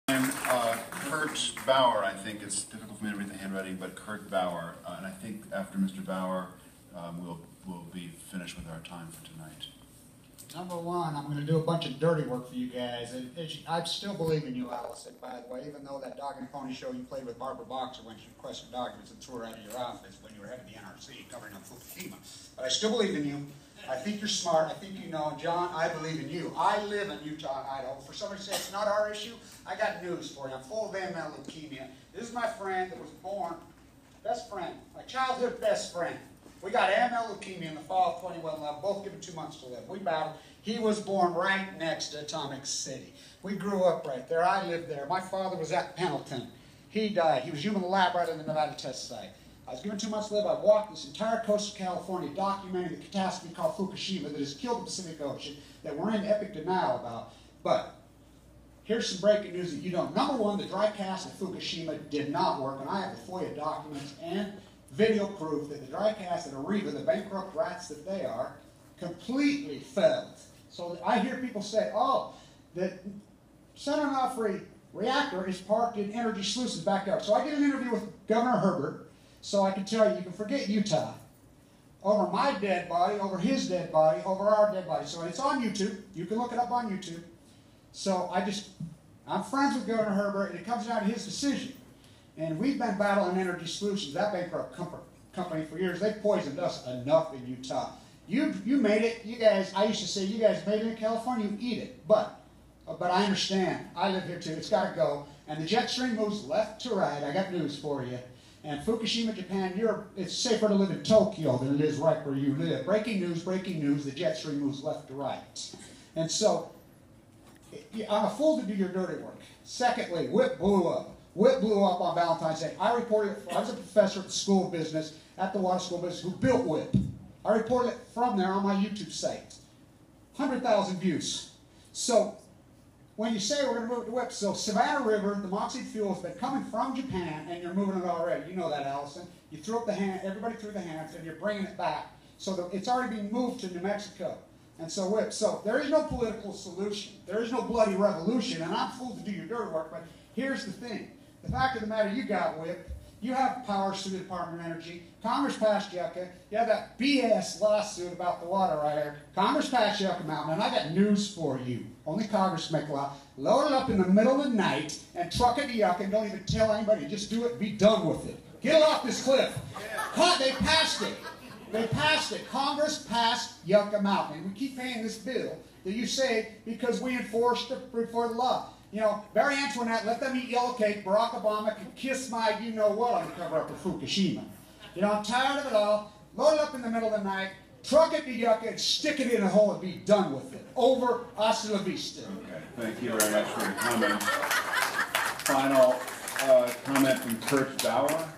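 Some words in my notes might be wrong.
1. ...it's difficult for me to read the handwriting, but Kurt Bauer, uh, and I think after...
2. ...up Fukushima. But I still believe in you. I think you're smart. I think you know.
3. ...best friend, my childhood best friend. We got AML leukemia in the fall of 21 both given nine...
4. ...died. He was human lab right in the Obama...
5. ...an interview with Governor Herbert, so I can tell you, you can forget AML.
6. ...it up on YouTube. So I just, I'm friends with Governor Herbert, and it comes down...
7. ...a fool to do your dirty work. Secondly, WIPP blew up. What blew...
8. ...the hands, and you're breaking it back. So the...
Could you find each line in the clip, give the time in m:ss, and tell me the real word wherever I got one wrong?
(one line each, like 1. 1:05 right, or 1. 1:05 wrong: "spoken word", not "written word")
1. 0:02 right
2. 0:21 right
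3. 0:34 wrong: "two", not "nine"
4. 0:47 wrong: "Nevada", not "Obama"
5. 1:17 wrong: "Utah", not "AML"
6. 1:26 right
7. 1:58 right
8. 2:20 wrong: "bringing", not "breaking".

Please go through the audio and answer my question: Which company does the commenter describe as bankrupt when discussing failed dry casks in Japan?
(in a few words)
Areva.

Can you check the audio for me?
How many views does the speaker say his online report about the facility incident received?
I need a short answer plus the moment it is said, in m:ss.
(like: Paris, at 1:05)
100,000, at 2:10.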